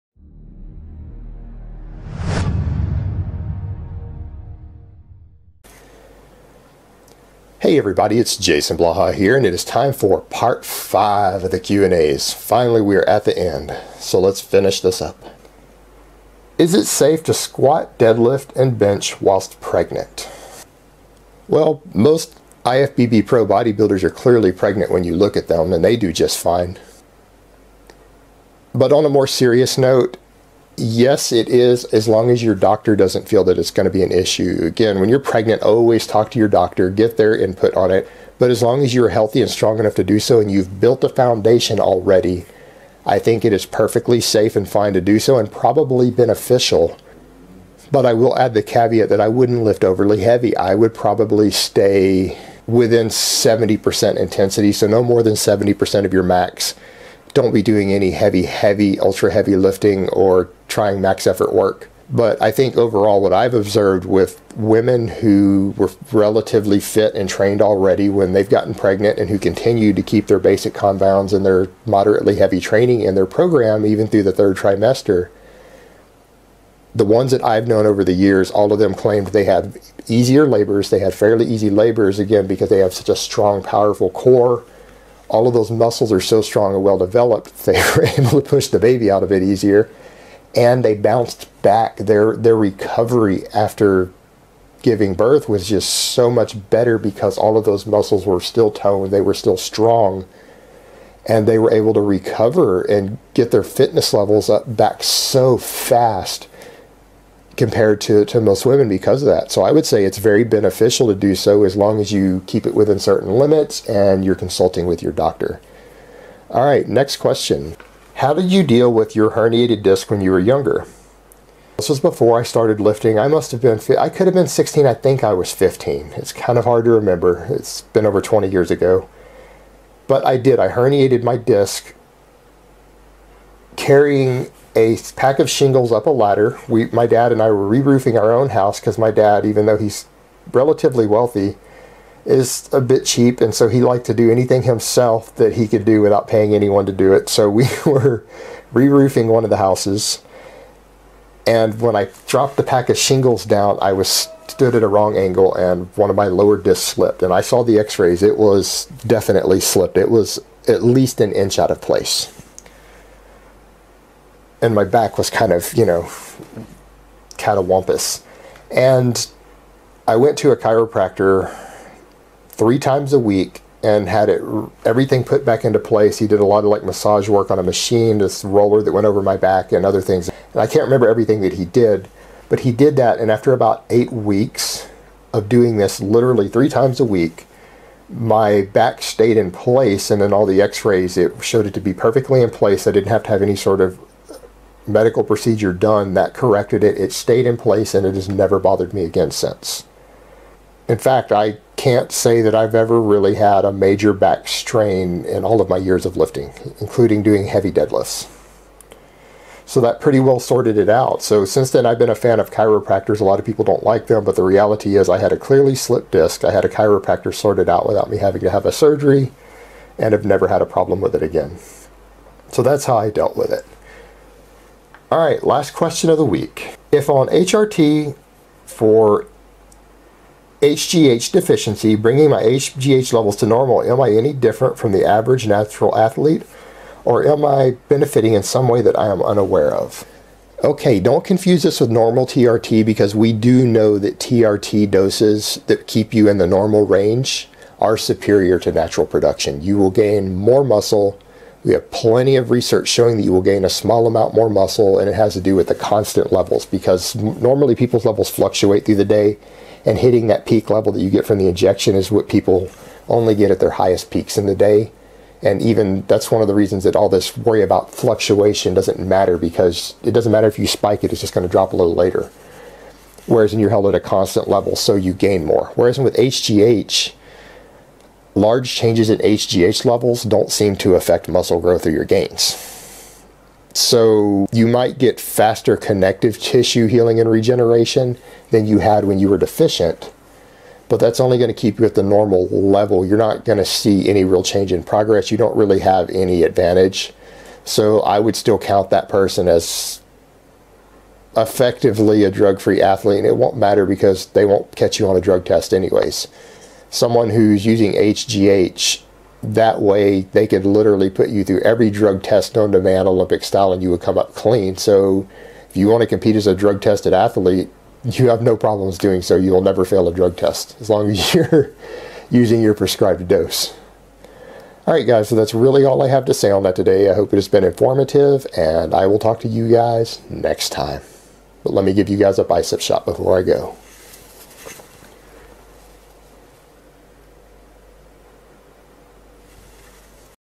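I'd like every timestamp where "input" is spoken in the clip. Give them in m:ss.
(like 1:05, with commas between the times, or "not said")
0:37.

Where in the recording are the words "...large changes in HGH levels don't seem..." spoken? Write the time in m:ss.
4:38.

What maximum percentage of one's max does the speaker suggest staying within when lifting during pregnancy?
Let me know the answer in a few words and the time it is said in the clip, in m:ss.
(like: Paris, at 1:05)
70%, at 0:53.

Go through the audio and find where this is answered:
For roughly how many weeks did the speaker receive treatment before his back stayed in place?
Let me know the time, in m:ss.
3:03.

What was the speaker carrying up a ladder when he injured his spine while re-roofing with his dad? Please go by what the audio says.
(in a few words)
a pack of shingles.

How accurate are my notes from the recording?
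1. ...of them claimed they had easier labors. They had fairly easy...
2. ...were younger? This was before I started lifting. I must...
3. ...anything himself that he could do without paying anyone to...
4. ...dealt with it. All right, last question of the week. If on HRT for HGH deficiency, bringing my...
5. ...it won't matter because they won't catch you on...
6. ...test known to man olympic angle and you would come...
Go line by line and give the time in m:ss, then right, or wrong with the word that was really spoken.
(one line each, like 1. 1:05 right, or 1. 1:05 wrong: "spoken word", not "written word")
1. 1:18 right
2. 2:00 right
3. 2:24 right
4. 3:43 right
5. 5:03 right
6. 5:12 wrong: "style", not "angle".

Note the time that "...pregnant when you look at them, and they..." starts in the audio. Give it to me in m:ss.
0:24.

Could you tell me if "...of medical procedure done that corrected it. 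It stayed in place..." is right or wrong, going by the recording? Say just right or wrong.
right.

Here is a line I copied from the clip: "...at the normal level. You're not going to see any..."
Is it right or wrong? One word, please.
right.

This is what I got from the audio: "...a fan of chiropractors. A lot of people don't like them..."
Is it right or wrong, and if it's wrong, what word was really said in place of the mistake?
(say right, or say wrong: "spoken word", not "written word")
right.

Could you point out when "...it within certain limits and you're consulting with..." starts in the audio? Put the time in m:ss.
1:52.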